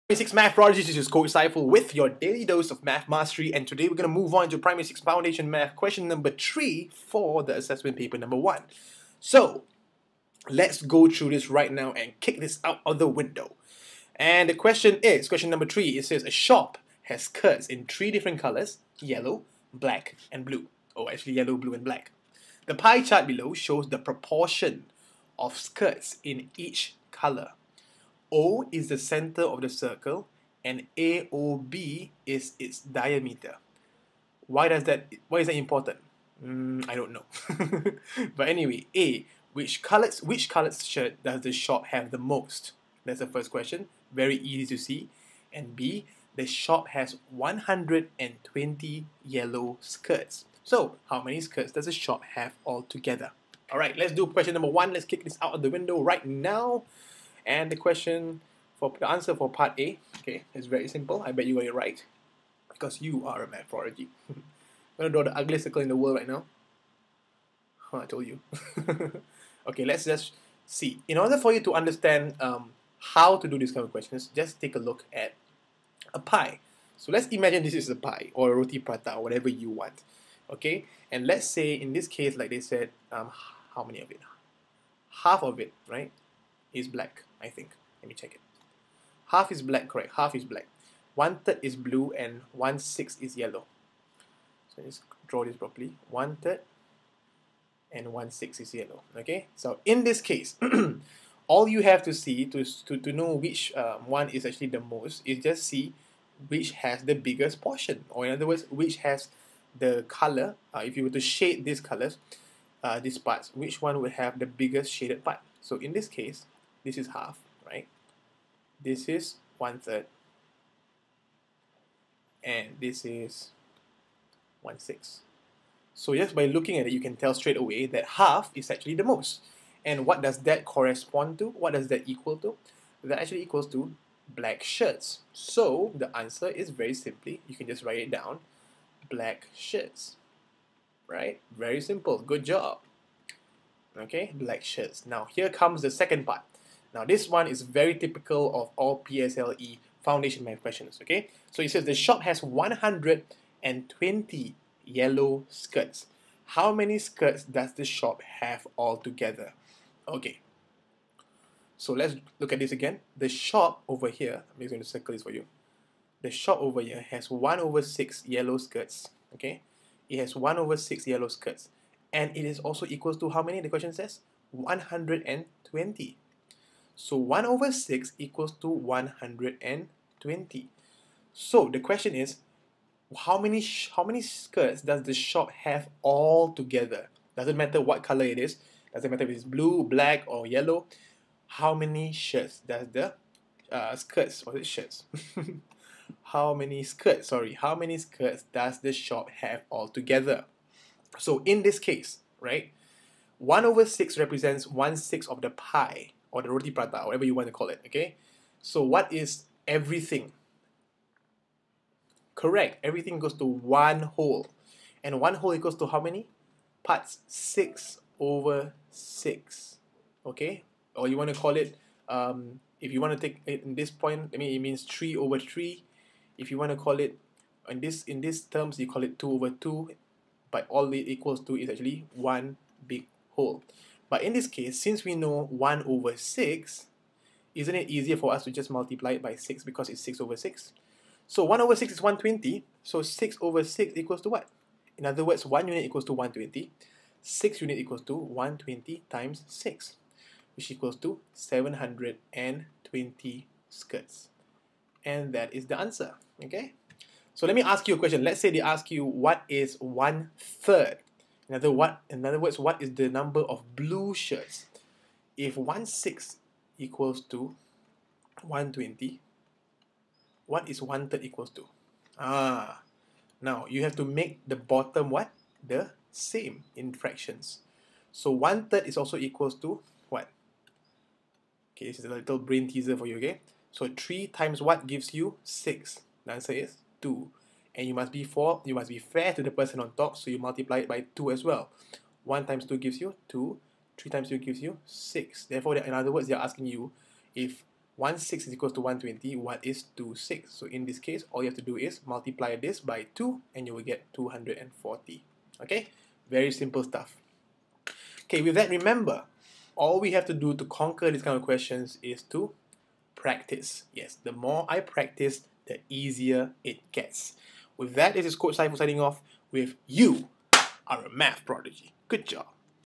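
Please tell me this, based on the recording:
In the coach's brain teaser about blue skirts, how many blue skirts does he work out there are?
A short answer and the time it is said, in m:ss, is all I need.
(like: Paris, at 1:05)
240, at 5:04.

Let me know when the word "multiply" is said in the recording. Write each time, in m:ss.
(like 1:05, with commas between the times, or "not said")
3:58, 4:50, 5:02.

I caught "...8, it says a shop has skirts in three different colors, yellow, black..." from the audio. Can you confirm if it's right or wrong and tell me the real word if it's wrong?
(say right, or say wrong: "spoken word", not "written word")
wrong: "3", not "8".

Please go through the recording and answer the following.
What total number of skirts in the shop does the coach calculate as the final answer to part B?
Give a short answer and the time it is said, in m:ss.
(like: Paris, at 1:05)
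720, at 4:11.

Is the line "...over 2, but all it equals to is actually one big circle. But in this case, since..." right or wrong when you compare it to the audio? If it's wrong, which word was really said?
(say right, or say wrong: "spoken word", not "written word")
wrong: "whole", not "circle".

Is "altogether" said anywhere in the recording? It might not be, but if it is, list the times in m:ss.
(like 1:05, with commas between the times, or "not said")
0:52, 2:38.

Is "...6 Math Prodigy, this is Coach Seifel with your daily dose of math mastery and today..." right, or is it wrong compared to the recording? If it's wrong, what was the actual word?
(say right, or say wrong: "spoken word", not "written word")
right.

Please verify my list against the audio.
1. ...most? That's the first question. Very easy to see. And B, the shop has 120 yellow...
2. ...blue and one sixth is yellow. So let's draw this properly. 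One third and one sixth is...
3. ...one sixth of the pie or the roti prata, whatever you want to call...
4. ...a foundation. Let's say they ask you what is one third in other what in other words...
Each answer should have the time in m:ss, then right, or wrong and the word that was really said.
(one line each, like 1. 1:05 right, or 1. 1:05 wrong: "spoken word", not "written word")
1. 0:42 right
2. 1:31 right
3. 3:24 right
4. 4:17 wrong: "question", not "foundation".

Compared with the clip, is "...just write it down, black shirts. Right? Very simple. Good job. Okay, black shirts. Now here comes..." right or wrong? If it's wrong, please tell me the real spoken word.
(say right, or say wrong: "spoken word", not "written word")
right.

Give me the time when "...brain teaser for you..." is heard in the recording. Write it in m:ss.
4:42.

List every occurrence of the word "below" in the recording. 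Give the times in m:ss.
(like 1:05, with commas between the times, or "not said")
0:23.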